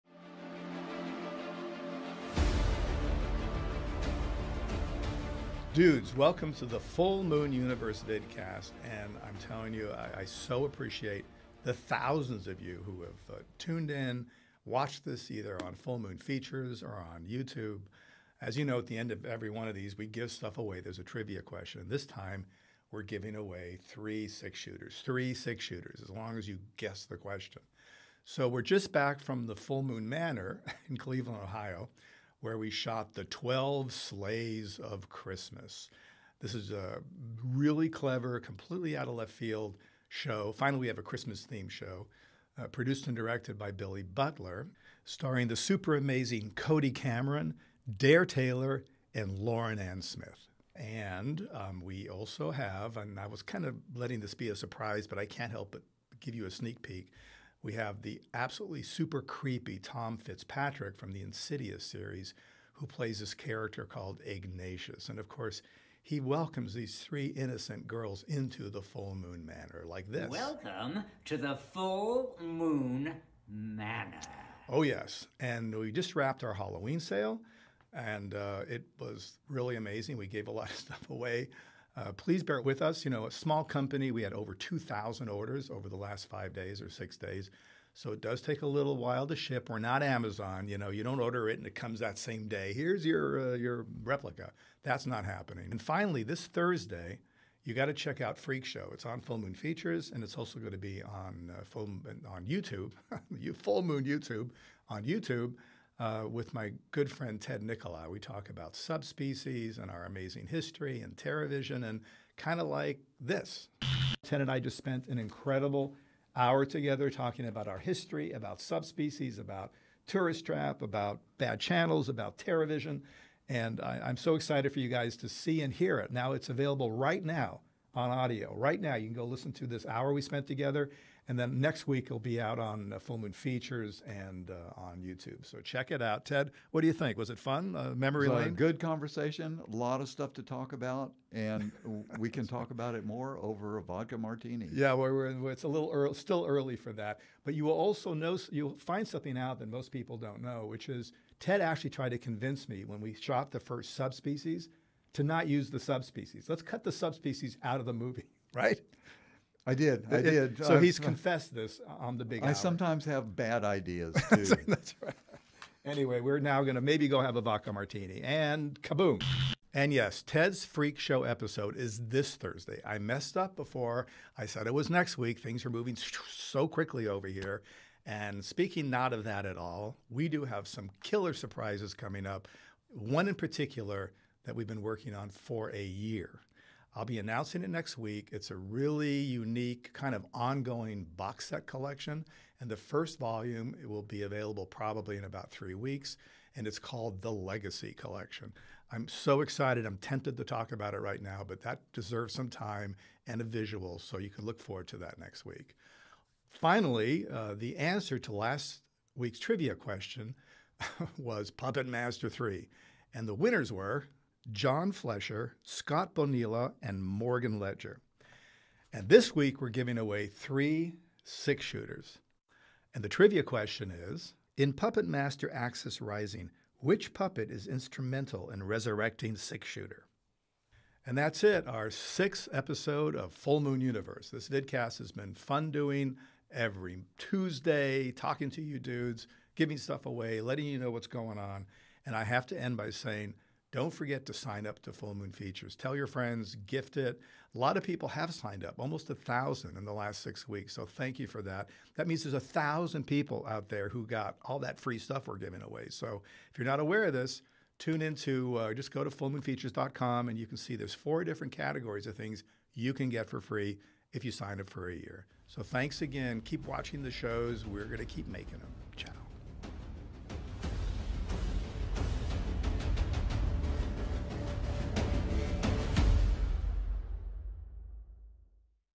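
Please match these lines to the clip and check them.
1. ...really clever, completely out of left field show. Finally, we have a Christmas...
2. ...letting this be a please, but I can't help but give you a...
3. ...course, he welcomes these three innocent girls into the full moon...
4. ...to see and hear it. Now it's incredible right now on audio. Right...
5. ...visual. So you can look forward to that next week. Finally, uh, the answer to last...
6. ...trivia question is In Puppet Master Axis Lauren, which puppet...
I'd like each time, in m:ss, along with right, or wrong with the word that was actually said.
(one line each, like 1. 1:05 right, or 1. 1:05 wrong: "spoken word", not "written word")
1. 0:37 right
2. 0:53 wrong: "surprise", not "please"
3. 1:05 right
4. 2:05 wrong: "available", not "incredible"
5. 3:23 right
6. 3:43 wrong: "Rising", not "Lauren".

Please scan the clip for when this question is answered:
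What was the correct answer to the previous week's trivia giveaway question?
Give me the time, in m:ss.
3:31.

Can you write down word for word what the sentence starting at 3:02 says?
One in particular that we've been working on for a year.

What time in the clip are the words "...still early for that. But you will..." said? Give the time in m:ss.
2:26.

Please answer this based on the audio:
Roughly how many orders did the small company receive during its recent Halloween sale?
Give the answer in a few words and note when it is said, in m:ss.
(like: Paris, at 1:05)
2,000, at 1:24.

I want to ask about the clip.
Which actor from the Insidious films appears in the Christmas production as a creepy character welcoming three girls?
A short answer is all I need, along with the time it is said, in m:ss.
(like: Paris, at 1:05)
Tom Fitzpatrick, at 0:59.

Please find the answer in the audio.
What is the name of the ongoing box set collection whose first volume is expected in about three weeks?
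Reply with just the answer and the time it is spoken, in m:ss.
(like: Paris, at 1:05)
The Legacy Collection, at 3:17.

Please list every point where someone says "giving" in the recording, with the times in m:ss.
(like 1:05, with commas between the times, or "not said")
0:23, 3:39, 3:59, 4:15.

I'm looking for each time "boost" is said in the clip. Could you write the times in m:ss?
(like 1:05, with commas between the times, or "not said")
not said.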